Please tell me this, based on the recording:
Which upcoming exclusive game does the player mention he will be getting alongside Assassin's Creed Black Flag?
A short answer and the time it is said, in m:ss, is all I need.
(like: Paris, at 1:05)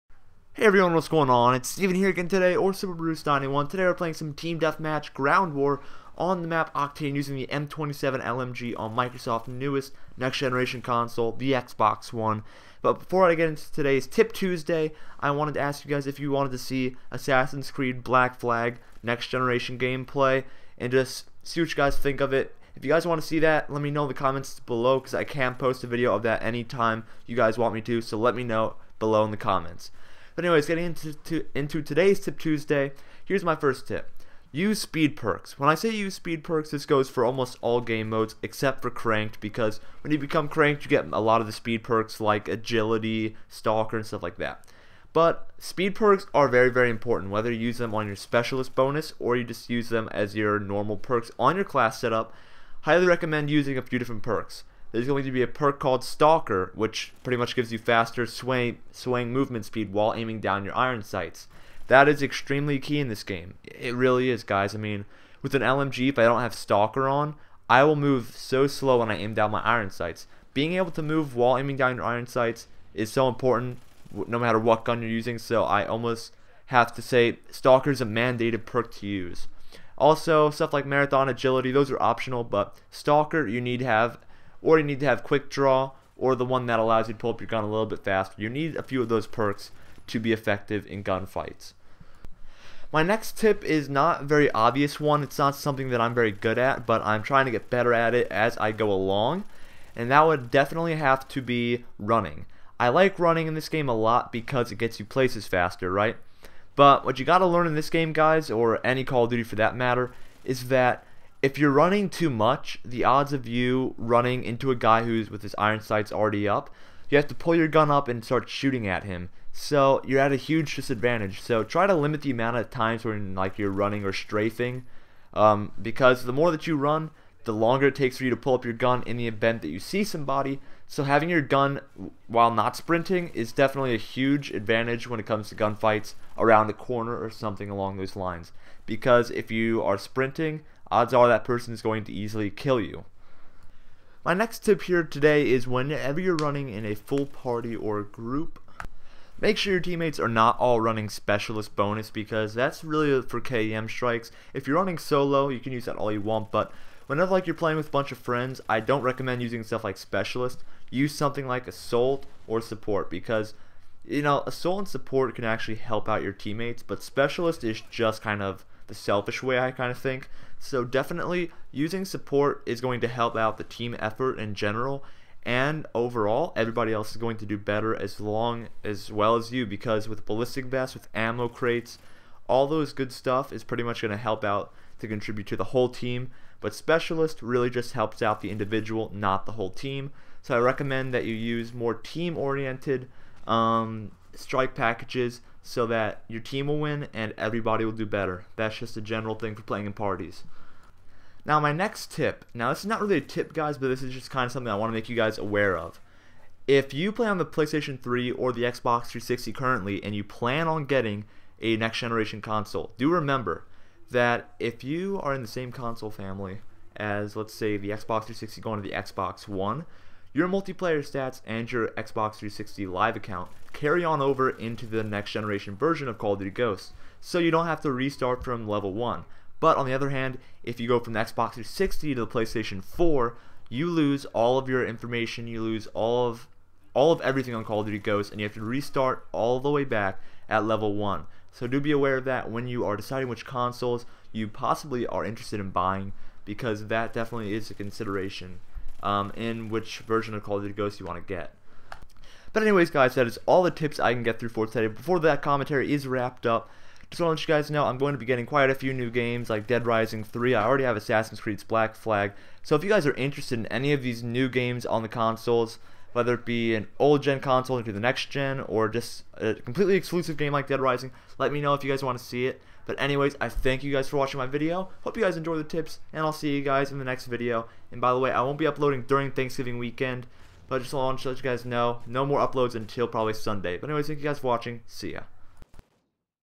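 Dead Rising 3, at 4:19.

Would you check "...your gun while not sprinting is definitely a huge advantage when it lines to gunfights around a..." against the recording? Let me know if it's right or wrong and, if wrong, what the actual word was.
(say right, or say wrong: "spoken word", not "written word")
wrong: "comes", not "lines".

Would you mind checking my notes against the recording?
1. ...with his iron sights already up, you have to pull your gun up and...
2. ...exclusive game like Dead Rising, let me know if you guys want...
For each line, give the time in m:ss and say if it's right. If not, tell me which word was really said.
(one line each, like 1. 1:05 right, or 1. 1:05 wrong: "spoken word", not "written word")
1. 1:55 right
2. 4:29 right.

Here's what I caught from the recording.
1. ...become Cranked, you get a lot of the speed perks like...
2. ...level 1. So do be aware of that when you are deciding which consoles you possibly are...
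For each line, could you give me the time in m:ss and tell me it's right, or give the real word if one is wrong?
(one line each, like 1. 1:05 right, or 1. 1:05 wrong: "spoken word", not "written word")
1. 0:40 right
2. 4:00 right.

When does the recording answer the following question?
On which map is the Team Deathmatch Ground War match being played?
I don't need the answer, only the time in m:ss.
0:06.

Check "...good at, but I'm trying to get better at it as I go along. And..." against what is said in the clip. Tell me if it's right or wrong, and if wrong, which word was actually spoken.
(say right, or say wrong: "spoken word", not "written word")
right.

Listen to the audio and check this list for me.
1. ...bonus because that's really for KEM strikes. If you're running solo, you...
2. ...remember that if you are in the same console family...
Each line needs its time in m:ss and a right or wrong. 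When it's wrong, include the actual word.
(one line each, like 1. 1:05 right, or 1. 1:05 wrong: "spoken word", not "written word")
1. 2:31 right
2. 3:33 right.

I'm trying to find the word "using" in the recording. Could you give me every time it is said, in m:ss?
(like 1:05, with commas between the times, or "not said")
0:07, 0:53, 1:15, 2:39, 2:51.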